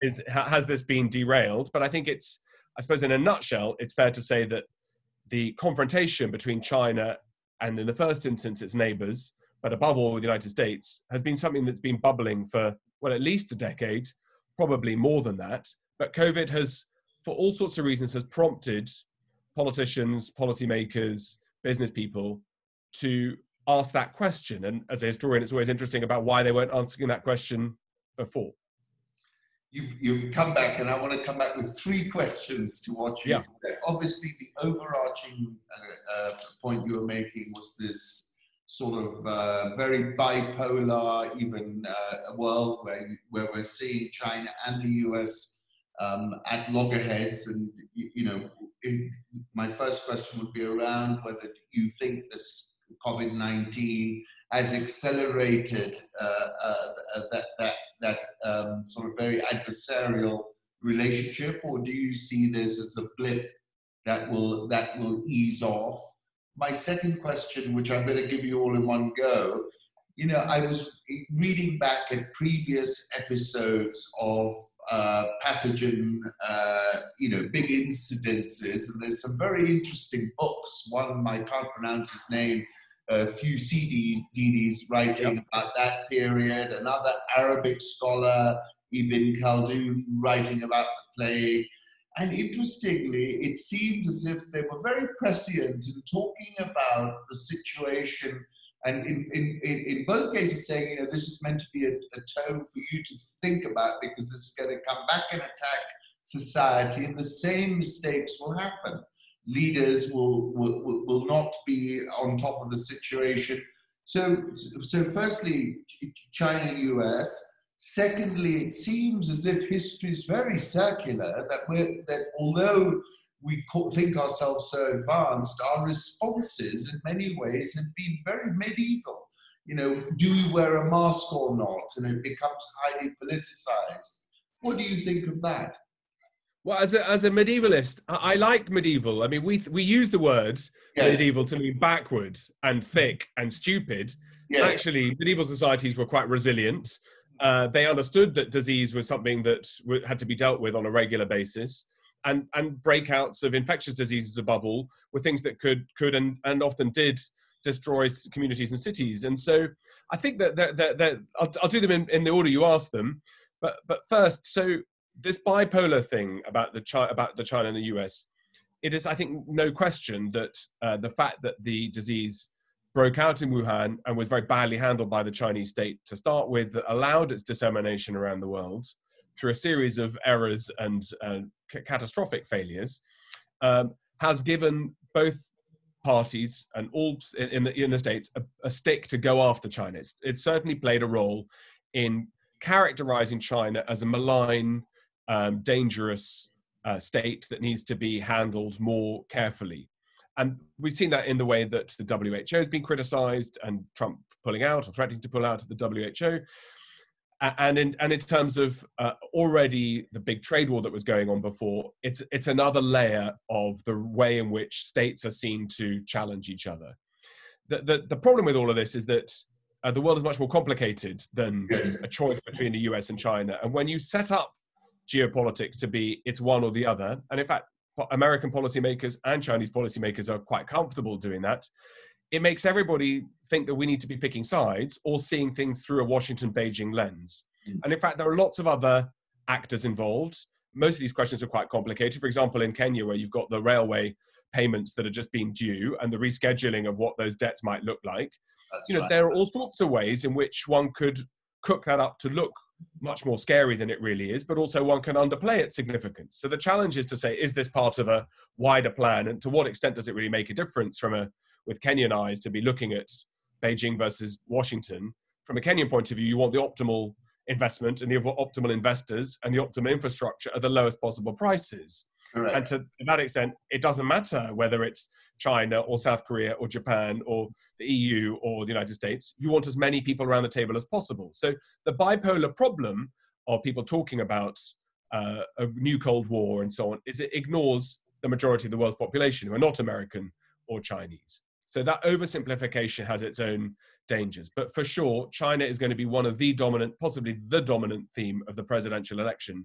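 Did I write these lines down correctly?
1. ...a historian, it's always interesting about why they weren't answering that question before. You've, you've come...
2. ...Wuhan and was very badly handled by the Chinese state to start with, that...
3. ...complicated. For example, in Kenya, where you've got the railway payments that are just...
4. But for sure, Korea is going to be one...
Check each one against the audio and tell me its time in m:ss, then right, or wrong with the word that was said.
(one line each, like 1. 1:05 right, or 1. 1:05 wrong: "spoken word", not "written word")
1. 0:25 right
2. 2:53 right
3. 4:01 right
4. 4:54 wrong: "China", not "Korea".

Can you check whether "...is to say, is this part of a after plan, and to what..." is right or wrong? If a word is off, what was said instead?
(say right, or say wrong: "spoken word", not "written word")
wrong: "wider", not "after".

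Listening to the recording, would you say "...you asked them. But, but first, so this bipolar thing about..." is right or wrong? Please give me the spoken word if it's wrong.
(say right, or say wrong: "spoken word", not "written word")
right.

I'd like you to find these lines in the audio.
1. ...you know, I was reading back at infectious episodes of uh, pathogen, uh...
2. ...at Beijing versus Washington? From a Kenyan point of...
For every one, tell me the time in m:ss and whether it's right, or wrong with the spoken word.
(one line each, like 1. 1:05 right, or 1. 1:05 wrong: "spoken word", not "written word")
1. 1:10 wrong: "previous", not "infectious"
2. 4:22 right.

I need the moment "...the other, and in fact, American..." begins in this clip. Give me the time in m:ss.
3:46.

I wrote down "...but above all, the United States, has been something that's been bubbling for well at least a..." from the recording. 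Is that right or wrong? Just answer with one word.
right.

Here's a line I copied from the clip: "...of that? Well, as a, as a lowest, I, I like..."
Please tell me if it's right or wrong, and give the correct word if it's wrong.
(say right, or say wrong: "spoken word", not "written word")
wrong: "medievalist", not "lowest".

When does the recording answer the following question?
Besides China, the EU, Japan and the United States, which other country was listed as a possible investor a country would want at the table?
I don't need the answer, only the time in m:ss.
4:35.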